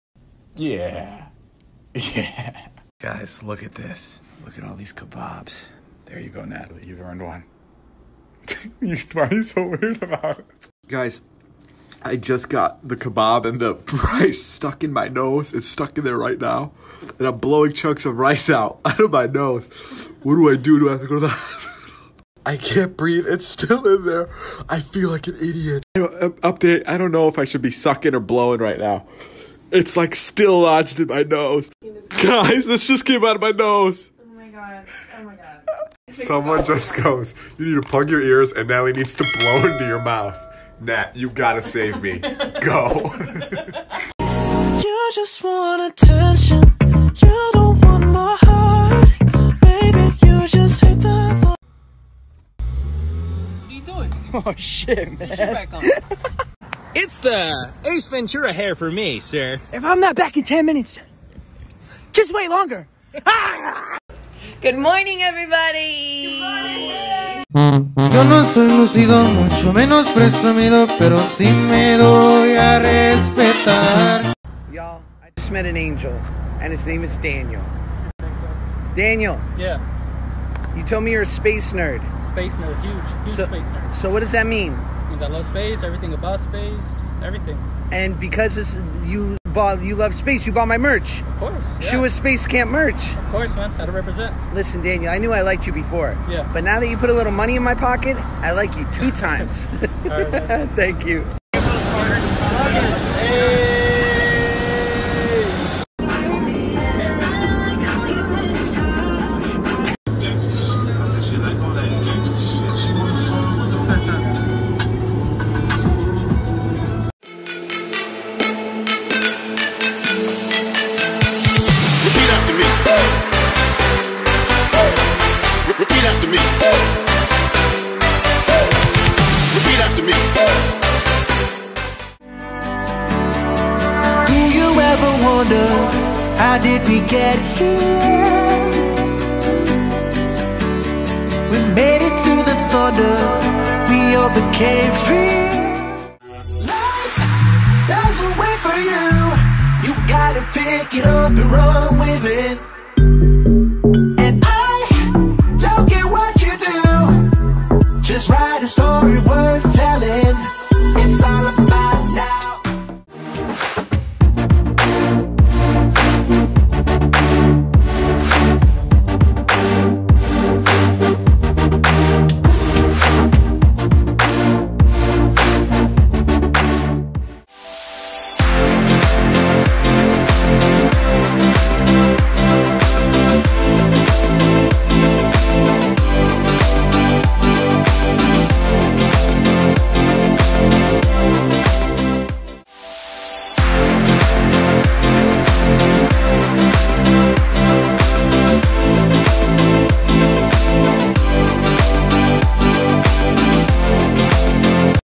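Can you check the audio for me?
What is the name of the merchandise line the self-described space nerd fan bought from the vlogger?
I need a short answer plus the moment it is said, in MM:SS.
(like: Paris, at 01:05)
Shoe Space Camp, at 01:31.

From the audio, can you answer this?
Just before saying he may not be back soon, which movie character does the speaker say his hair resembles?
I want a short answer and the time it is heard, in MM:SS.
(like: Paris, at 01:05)
Ace Ventura, at 00:57.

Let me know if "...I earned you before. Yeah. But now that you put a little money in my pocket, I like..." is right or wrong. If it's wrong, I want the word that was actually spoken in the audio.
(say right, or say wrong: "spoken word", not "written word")
wrong: "liked", not "earned".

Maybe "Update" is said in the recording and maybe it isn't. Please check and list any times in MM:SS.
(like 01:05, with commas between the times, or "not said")
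00:25.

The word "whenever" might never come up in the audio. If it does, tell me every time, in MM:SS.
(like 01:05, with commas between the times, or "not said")
not said.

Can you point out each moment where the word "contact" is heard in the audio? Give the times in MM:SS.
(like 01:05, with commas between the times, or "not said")
not said.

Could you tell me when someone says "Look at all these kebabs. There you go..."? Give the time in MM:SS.
00:04.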